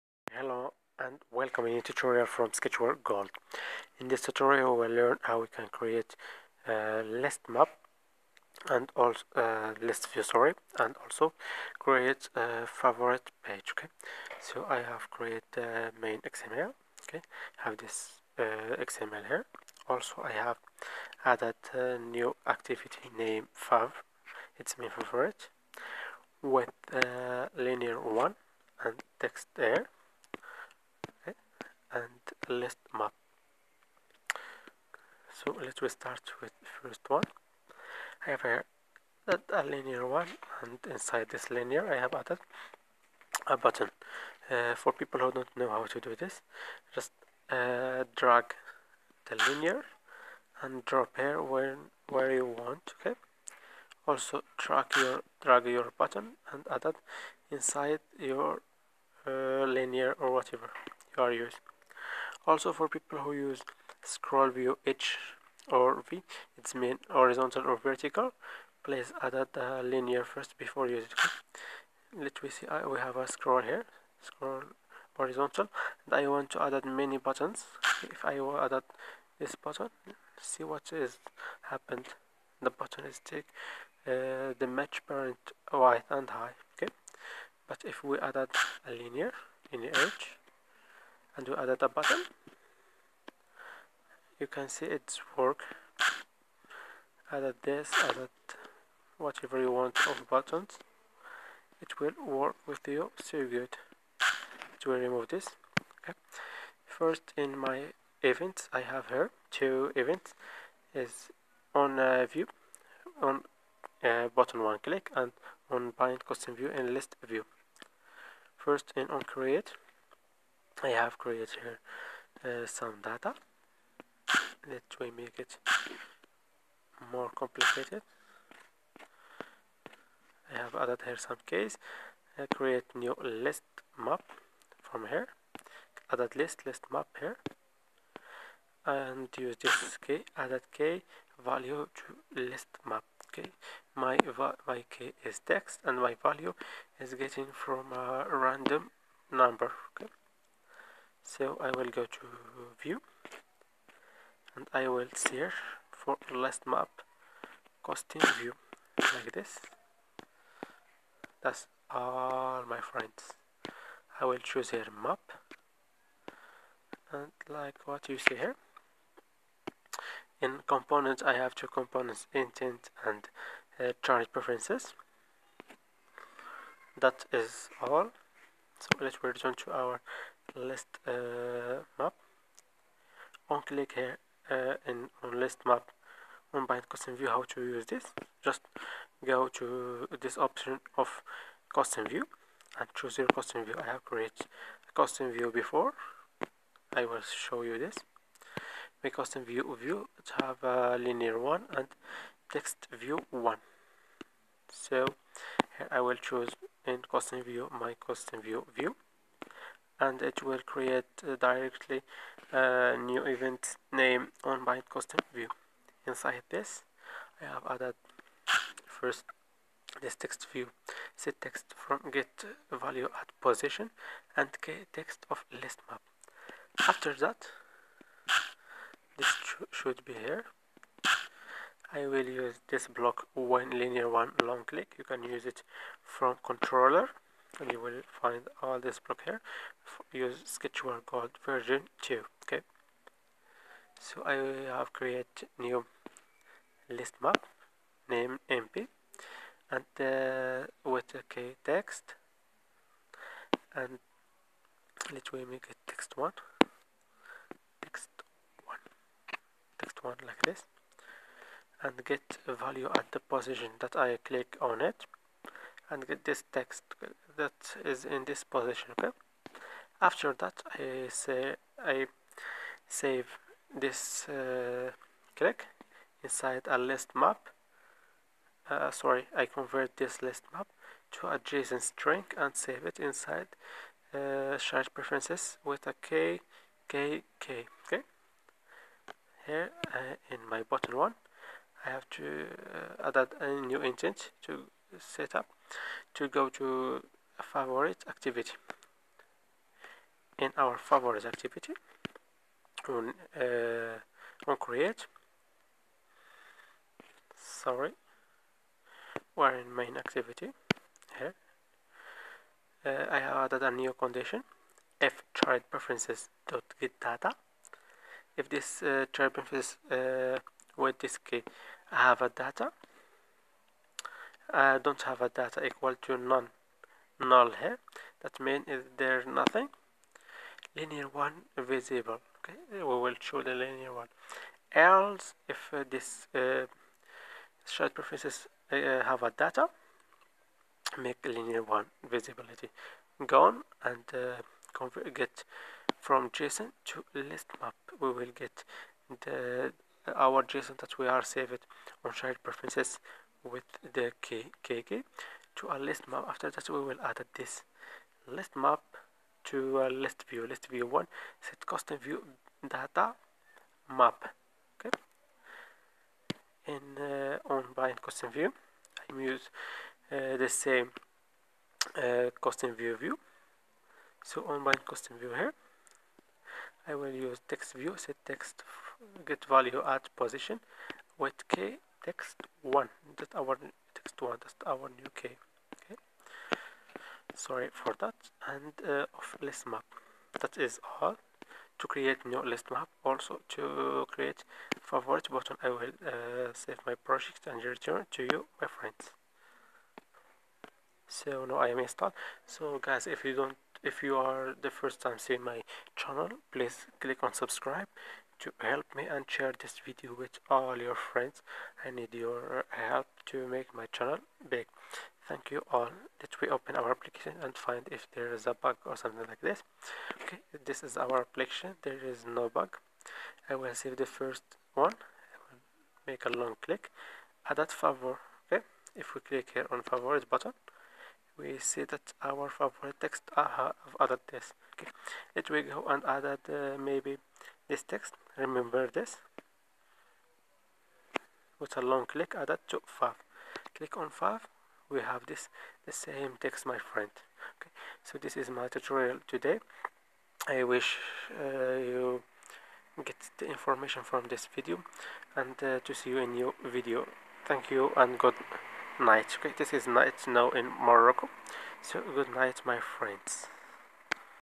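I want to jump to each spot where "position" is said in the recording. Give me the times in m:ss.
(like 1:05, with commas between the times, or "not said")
3:43, 4:23, 4:28, 6:20.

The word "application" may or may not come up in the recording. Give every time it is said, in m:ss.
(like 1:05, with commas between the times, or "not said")
6:56, 7:01.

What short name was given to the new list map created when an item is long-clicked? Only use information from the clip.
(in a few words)
MP.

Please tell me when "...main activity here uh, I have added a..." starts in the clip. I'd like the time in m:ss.
5:09.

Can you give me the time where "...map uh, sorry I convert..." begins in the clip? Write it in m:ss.
4:37.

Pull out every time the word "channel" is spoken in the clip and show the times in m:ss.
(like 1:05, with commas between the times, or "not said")
6:45, 6:53.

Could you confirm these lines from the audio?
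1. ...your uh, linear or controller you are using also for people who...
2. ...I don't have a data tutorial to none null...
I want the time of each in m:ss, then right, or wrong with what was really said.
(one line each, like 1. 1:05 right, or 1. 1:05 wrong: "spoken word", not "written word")
1. 0:58 wrong: "whatever", not "controller"
2. 5:24 wrong: "equal", not "tutorial".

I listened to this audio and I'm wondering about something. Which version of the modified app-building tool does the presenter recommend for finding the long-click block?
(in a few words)
Sketchware Gold version 2.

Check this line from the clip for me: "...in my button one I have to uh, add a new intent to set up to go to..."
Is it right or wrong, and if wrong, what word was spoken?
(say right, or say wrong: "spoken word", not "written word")
right.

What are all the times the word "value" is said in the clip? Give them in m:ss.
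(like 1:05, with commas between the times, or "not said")
2:21, 2:26, 3:42, 4:22, 6:19.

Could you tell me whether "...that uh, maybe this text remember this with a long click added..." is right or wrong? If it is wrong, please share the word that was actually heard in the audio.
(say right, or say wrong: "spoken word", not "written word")
right.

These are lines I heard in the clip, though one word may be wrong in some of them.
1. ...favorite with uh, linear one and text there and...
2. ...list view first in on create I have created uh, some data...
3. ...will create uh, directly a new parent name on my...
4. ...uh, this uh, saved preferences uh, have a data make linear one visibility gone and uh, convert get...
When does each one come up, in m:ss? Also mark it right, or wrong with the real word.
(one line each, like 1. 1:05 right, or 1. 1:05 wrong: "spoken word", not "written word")
1. 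0:24 right
2. 1:56 right
3. 3:30 wrong: "event", not "parent"
4. 5:35 wrong: "shared", not "saved".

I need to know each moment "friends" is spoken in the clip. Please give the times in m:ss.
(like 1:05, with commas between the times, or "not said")
2:42, 6:38, 6:50, 7:26, 7:42.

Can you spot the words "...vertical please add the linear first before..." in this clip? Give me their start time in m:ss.
1:07.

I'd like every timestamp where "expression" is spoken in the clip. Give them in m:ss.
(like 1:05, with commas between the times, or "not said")
not said.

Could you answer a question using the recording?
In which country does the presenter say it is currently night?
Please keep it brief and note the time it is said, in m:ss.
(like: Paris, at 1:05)
Morocco, at 7:40.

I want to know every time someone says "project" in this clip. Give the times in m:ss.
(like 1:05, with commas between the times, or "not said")
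6:36.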